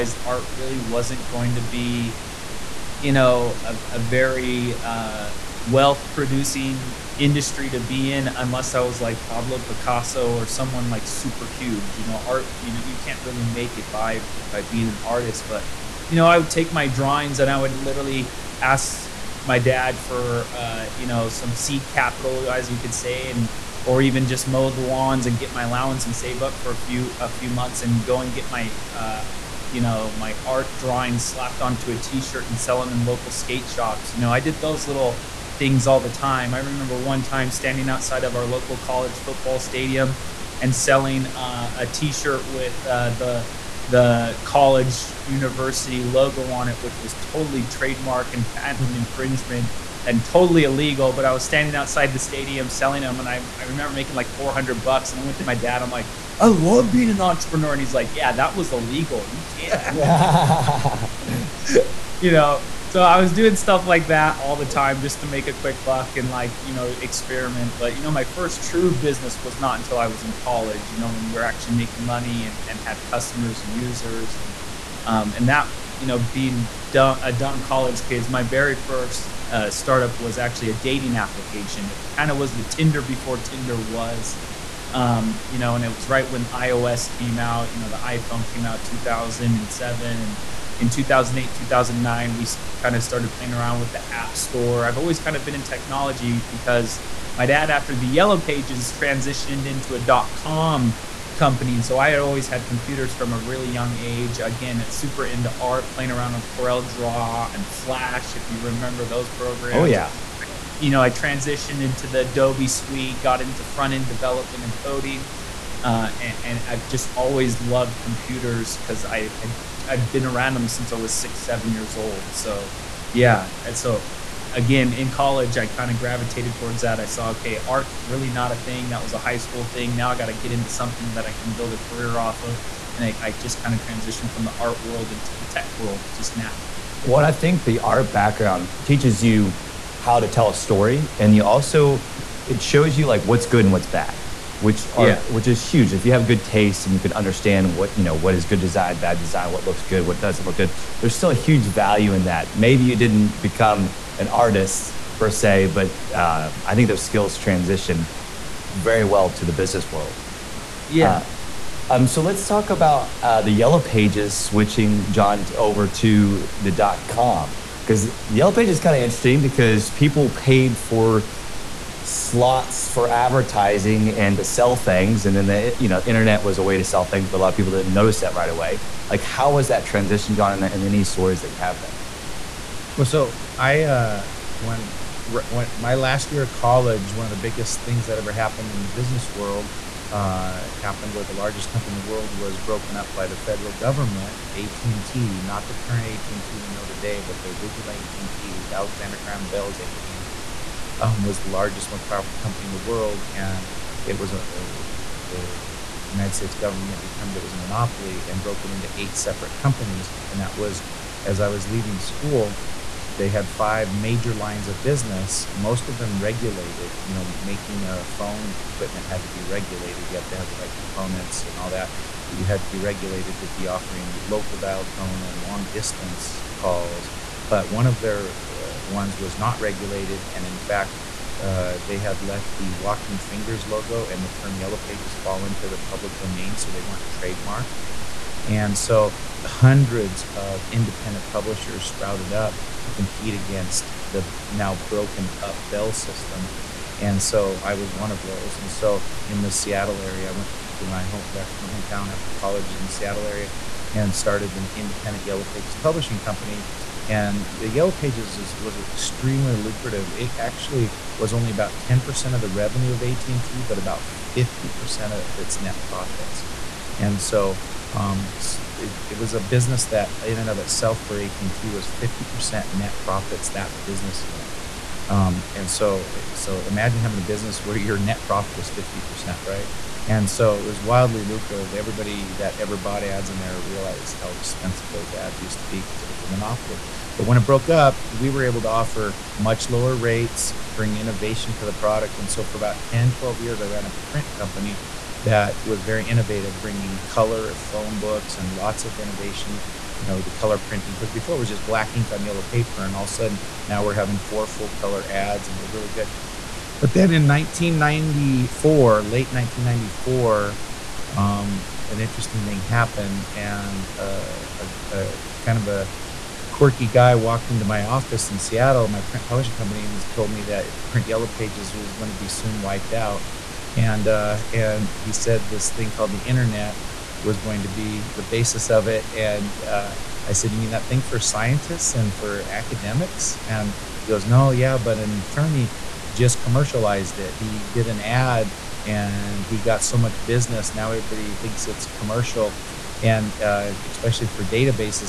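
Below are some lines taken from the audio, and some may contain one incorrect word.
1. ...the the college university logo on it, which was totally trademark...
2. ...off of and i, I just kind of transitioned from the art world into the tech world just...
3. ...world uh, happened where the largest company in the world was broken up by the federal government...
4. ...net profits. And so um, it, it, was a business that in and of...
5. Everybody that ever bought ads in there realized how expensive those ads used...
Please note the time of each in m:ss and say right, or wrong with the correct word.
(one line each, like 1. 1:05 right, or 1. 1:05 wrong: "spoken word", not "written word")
1. 0:43 right
2. 2:12 right
3. 3:09 right
4. 4:25 right
5. 4:41 right.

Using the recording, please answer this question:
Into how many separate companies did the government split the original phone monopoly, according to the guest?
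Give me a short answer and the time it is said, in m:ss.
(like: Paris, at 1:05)
8, at 3:28.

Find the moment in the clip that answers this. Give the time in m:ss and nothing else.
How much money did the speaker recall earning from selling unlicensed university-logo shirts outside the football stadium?
0:54.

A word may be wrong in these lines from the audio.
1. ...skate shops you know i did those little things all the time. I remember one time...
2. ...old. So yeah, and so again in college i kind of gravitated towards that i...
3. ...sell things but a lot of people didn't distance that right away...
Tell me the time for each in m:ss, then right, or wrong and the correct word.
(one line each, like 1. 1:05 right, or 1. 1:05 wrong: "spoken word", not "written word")
1. 0:33 right
2. 2:01 right
3. 2:56 wrong: "notice", not "distance".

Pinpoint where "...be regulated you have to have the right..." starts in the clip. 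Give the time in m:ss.
3:39.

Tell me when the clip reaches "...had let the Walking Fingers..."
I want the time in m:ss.
3:51.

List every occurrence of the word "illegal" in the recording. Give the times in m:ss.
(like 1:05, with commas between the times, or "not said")
0:50, 0:58.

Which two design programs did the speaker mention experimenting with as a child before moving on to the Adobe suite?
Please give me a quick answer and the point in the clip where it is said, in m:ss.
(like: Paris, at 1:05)
Corel Draw and Flash, at 1:46.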